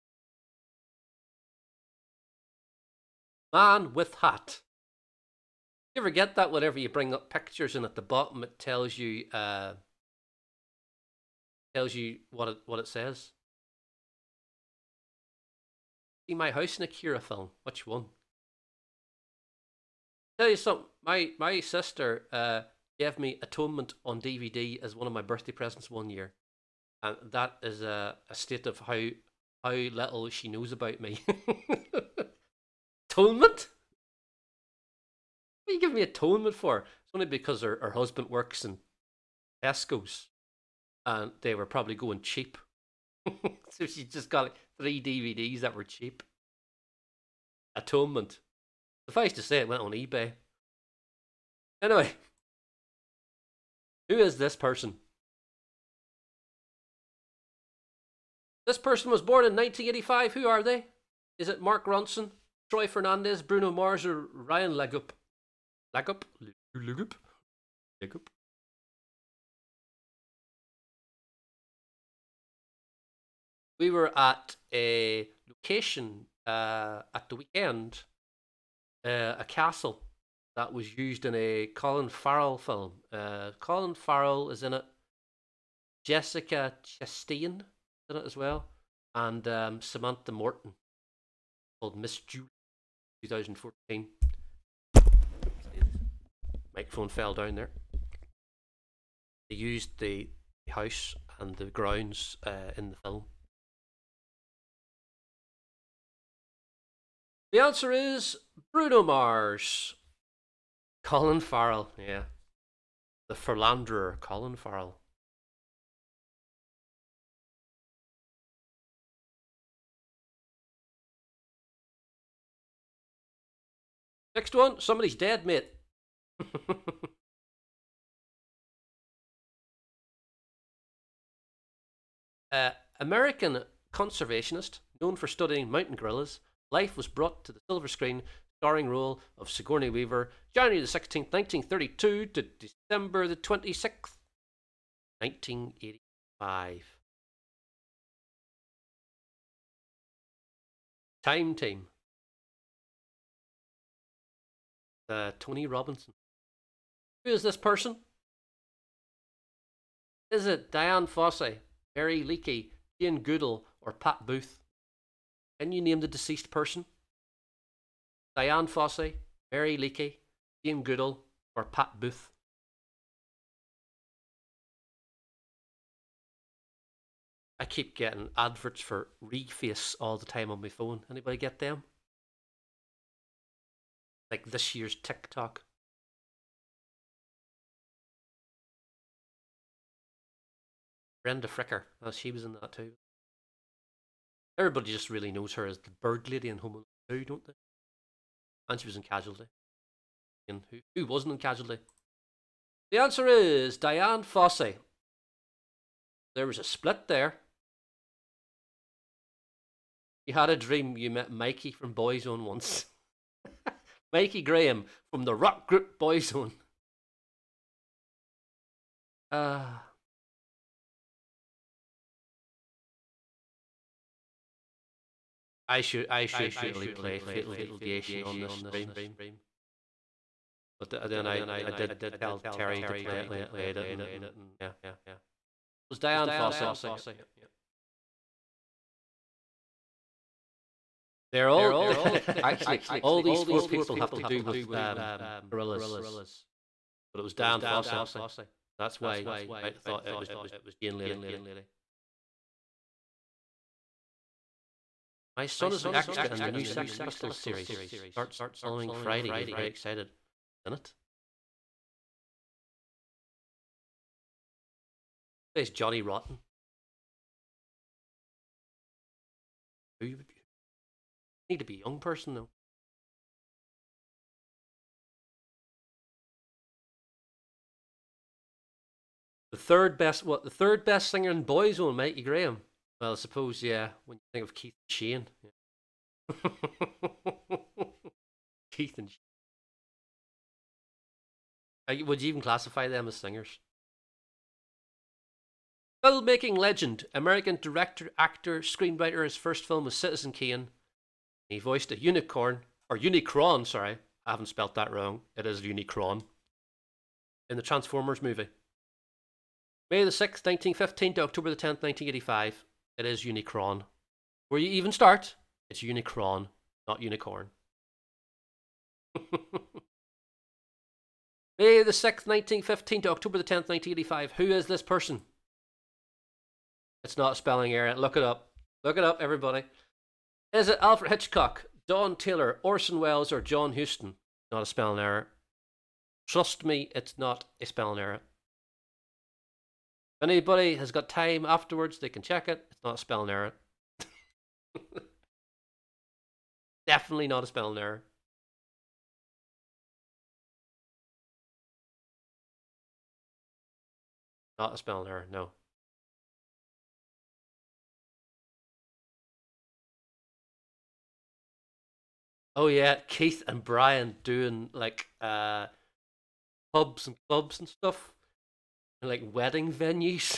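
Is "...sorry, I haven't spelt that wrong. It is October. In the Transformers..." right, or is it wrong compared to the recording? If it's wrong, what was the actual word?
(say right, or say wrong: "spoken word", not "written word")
wrong: "Unicron", not "October".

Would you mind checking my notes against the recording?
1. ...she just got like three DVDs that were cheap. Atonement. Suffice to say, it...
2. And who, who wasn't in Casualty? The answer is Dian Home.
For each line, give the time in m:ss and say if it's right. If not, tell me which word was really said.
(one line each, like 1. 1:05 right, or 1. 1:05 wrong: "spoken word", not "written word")
1. 0:43 right
2. 3:20 wrong: "Fossey", not "Home".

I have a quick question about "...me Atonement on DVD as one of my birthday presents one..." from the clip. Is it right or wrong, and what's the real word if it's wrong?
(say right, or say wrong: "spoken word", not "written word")
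right.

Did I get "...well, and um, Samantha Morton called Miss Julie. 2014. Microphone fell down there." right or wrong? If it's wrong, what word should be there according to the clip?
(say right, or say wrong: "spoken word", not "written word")
right.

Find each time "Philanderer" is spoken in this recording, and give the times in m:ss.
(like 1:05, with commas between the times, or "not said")
1:53.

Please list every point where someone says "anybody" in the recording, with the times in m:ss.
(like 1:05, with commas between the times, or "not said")
3:01, 5:40.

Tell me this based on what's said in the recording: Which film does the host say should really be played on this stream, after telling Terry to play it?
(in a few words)
Fatal Deviation.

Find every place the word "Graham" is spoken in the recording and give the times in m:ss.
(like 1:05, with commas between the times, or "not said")
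3:34, 4:42.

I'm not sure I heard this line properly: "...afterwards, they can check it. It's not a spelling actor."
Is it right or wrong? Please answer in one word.
wrong.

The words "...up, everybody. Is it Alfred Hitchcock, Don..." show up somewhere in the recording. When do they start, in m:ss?
5:29.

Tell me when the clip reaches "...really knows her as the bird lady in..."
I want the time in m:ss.
3:15.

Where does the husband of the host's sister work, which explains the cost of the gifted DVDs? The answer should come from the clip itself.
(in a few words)
Tesco's.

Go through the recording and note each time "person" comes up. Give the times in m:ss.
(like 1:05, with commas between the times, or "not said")
0:54, 0:58, 2:37, 2:46, 4:31, 5:24.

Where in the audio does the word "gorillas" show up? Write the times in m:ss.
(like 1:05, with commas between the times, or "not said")
2:15, 4:05.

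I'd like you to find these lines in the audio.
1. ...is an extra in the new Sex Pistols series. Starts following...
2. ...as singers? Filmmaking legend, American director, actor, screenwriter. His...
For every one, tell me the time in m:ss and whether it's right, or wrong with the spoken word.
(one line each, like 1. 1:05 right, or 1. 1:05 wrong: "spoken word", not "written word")
1. 4:15 right
2. 4:53 right.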